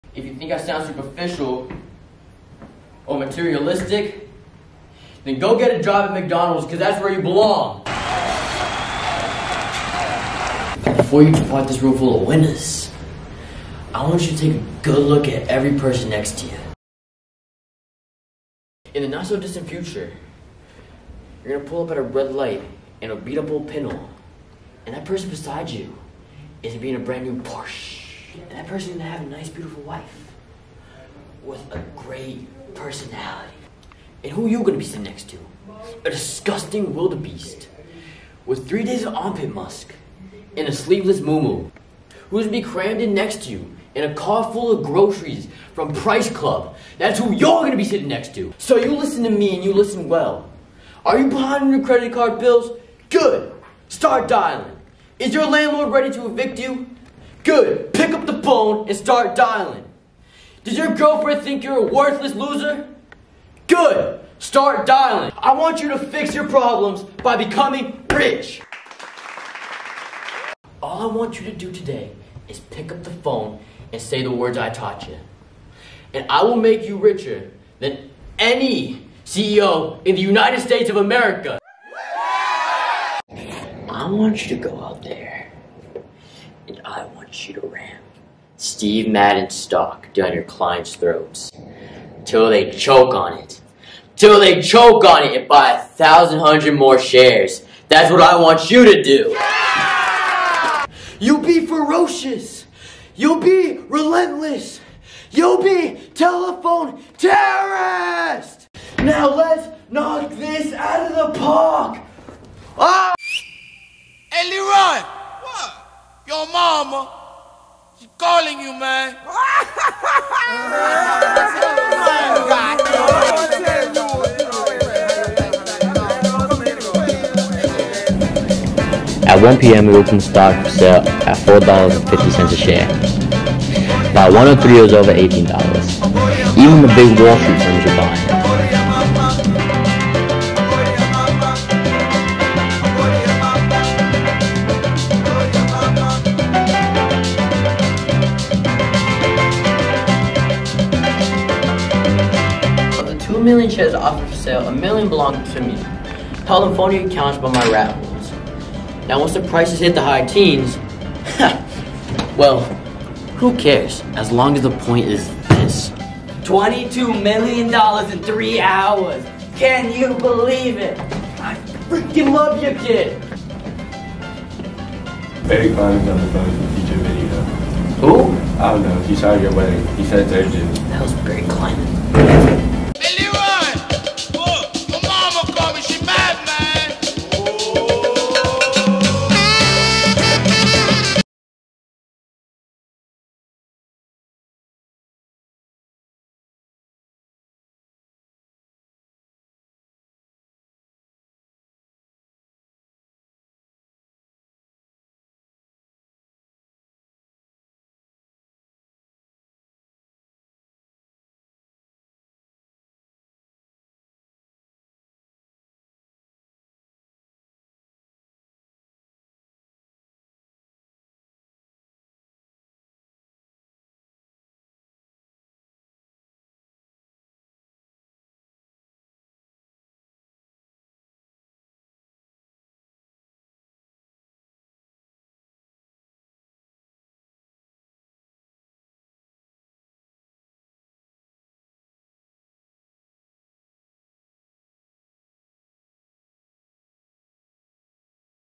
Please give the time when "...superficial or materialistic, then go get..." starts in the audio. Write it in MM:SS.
00:00.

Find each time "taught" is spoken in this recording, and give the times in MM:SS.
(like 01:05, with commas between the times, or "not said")
01:14.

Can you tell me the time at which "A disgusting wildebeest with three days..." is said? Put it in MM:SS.
00:36.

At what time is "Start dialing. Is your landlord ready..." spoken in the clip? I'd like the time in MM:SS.
00:53.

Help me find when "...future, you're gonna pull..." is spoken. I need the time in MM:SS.
00:19.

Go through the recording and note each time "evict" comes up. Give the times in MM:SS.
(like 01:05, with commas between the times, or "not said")
00:56.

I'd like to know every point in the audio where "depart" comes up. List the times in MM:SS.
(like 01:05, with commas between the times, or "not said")
00:11.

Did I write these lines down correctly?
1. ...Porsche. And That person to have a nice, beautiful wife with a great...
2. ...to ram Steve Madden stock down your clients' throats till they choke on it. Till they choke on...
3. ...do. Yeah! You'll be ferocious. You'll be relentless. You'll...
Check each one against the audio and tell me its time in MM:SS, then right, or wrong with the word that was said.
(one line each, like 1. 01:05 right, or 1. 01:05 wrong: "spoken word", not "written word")
1. 00:27 right
2. 01:27 right
3. 01:39 right.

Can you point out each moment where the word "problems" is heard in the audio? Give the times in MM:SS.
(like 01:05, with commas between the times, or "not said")
01:06.